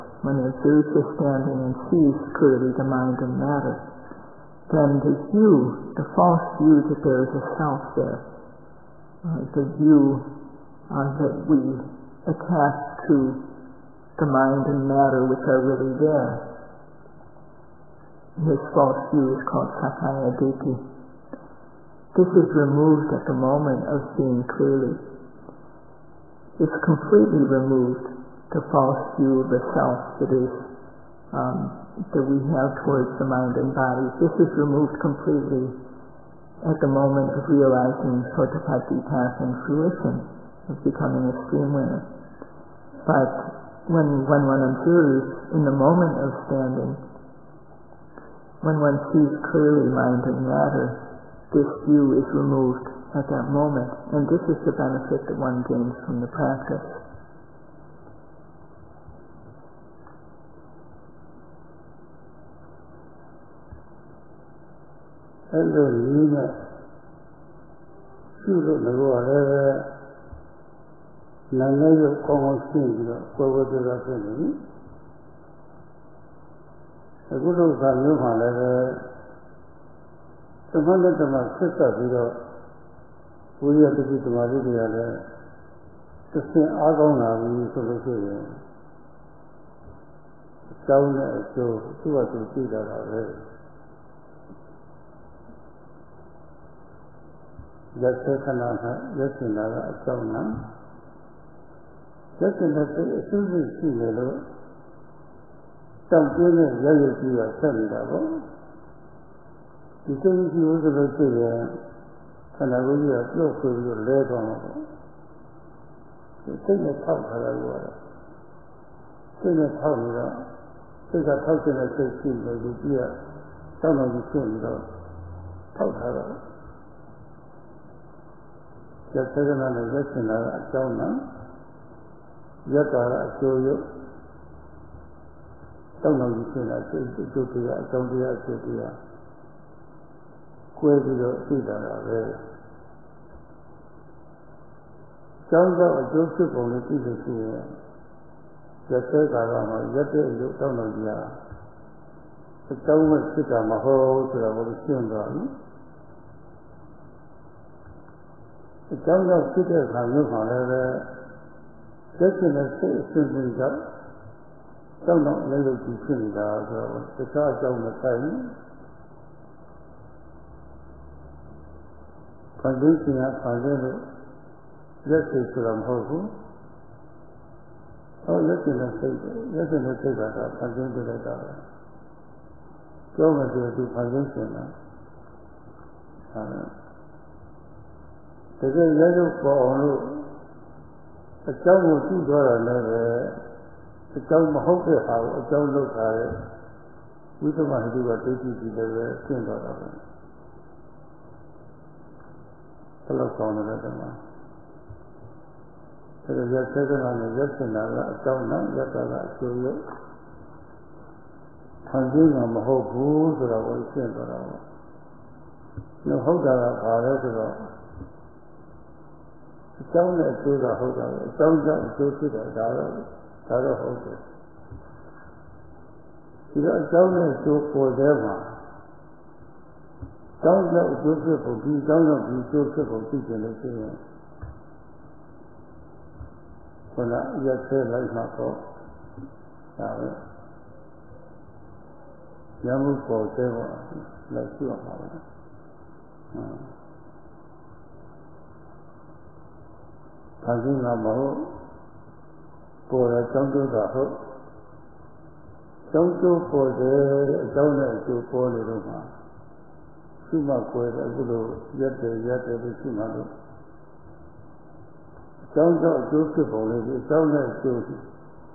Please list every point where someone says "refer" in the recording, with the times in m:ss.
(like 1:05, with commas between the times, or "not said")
not said.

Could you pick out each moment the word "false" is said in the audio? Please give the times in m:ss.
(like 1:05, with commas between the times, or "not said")
0:06, 0:18, 0:28.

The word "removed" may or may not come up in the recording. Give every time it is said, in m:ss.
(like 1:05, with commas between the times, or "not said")
0:22, 0:27, 0:34, 0:52.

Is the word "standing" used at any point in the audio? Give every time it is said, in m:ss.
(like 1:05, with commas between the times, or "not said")
0:01, 0:46.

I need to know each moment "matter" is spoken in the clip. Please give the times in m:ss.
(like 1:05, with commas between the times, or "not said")
0:03, 0:14, 0:50.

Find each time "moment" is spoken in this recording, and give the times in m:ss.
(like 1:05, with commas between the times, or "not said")
0:23, 0:36, 0:45, 0:53.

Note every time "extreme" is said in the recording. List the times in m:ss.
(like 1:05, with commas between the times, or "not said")
0:41.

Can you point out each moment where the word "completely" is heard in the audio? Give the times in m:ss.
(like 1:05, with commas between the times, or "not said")
0:26, 0:35.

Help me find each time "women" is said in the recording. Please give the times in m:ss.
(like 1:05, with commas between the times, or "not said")
0:41.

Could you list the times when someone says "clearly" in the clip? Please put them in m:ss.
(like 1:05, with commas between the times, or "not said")
0:02, 0:24, 0:49.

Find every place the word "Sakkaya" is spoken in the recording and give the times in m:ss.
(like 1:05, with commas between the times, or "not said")
0:19.